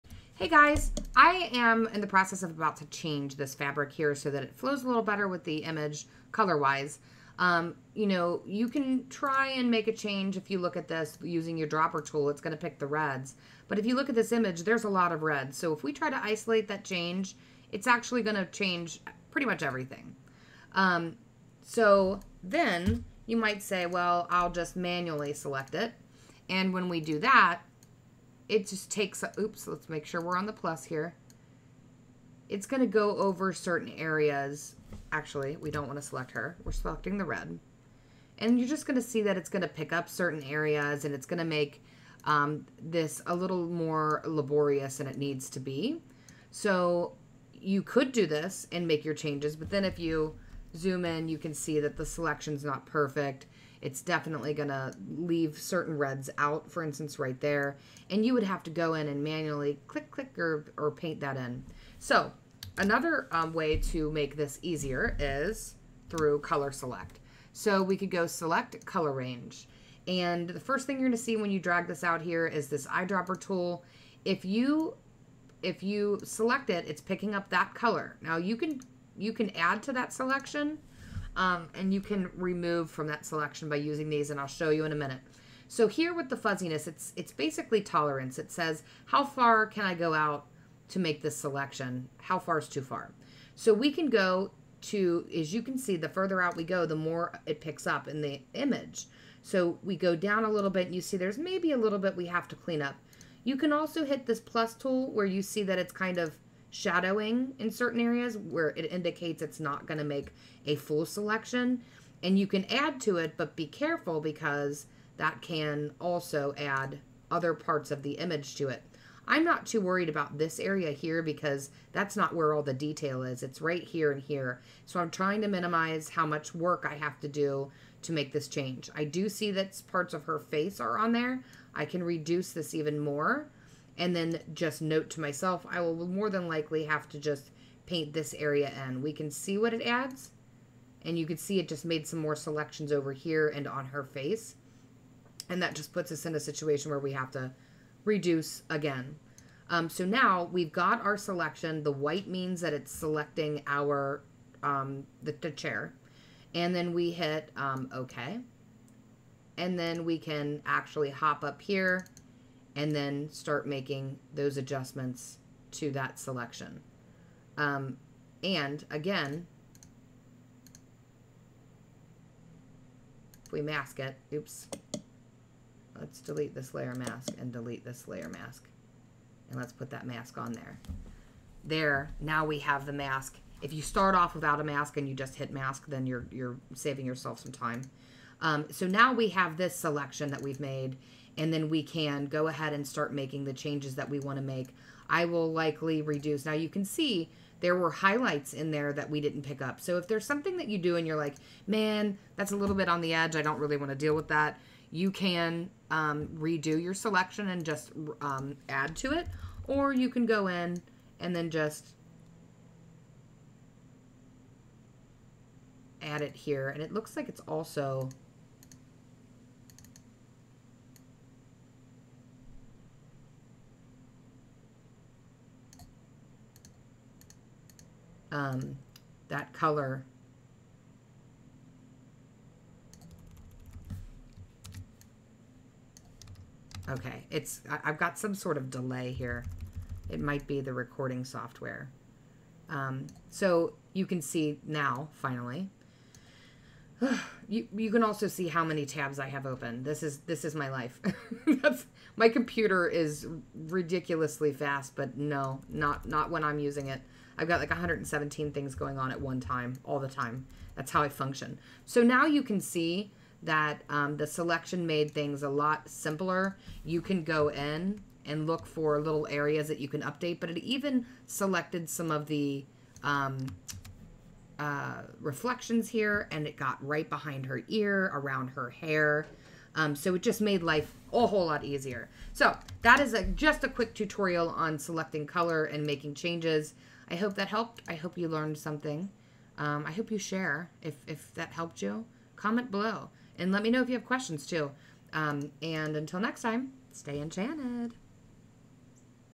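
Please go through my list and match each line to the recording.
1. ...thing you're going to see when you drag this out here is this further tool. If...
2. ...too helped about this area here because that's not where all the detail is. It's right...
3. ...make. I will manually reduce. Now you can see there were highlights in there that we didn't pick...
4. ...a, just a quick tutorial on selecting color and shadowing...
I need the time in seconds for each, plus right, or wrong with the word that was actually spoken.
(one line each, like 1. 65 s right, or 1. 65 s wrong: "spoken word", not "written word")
1. 70 s wrong: "eyedropper", not "further"
2. 119 s wrong: "worried", not "helped"
3. 194 s wrong: "likely", not "manually"
4. 283 s wrong: "making", not "shadowing".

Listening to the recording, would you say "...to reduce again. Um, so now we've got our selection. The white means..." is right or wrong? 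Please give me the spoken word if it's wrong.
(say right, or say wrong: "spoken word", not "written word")
right.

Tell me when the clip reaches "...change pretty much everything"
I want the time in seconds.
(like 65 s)
18 s.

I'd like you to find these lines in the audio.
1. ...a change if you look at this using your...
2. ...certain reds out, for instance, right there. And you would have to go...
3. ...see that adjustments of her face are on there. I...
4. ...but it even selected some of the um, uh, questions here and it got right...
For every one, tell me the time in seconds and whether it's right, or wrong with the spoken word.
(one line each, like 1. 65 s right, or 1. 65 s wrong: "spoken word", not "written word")
1. 9 s right
2. 55 s right
3. 129 s wrong: "parts", not "adjustments"
4. 270 s wrong: "reflections", not "questions".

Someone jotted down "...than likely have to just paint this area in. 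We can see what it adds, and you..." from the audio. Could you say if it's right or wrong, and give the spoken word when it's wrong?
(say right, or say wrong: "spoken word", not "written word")
right.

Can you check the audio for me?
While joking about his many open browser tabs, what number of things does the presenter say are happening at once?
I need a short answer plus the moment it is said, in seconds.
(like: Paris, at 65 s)
117, at 257 s.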